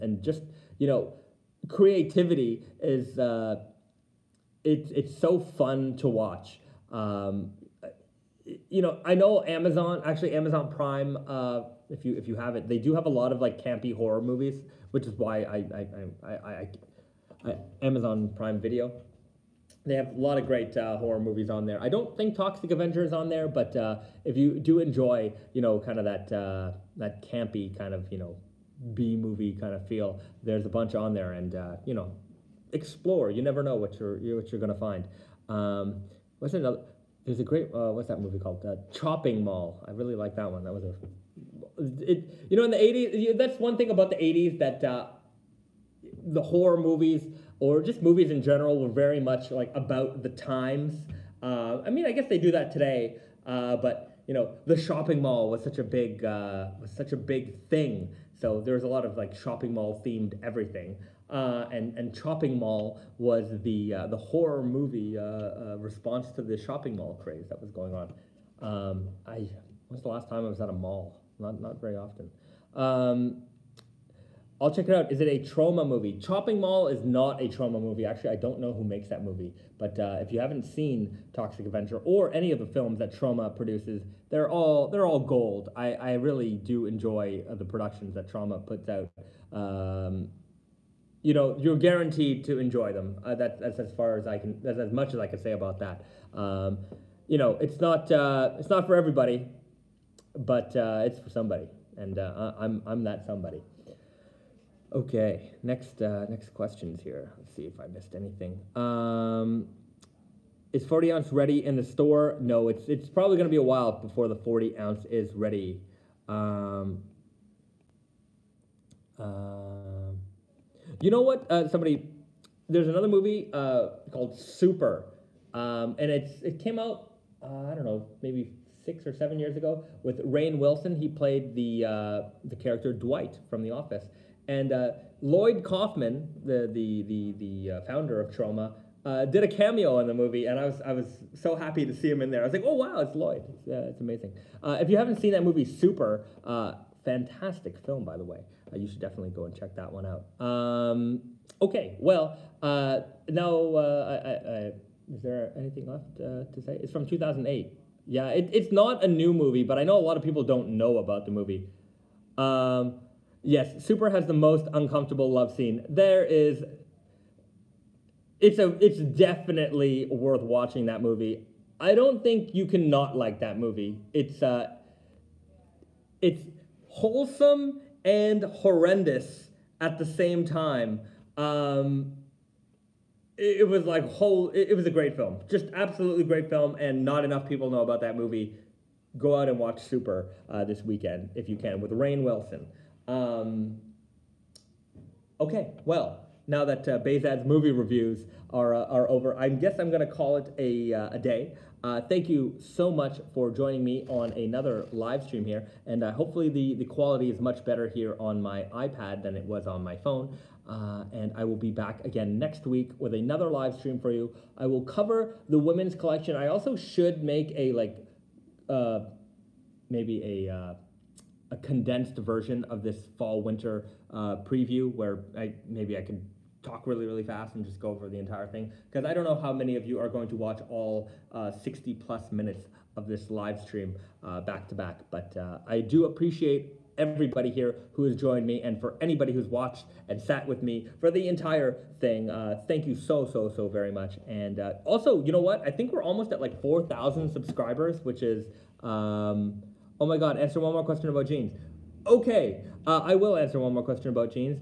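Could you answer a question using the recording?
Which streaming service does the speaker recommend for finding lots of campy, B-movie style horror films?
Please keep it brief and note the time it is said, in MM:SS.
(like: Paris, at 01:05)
Amazon Prime Video, at 00:17.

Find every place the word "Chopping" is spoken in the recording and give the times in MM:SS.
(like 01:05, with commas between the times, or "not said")
00:38, 01:02, 01:16.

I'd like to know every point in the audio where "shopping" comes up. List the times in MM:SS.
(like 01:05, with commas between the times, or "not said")
00:54, 00:59, 01:06.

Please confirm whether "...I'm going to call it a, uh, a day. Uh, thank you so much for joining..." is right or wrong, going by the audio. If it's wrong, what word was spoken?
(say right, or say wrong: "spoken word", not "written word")
right.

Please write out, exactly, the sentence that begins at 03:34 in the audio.
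I will cover the women's collection.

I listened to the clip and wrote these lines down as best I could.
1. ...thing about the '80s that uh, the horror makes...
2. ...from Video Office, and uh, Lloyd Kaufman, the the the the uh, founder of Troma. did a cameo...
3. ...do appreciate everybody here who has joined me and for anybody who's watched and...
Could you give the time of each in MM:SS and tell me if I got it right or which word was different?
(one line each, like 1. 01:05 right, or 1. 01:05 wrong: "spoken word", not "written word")
1. 00:43 wrong: "movies", not "makes"
2. 02:13 wrong: "The", not "Video"
3. 03:55 right.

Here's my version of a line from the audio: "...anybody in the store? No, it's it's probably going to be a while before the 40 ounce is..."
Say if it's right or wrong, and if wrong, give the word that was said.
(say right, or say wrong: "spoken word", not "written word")
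wrong: "ready", not "anybody".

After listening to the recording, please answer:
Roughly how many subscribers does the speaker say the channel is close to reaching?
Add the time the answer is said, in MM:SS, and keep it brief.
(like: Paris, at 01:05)
4,000, at 04:06.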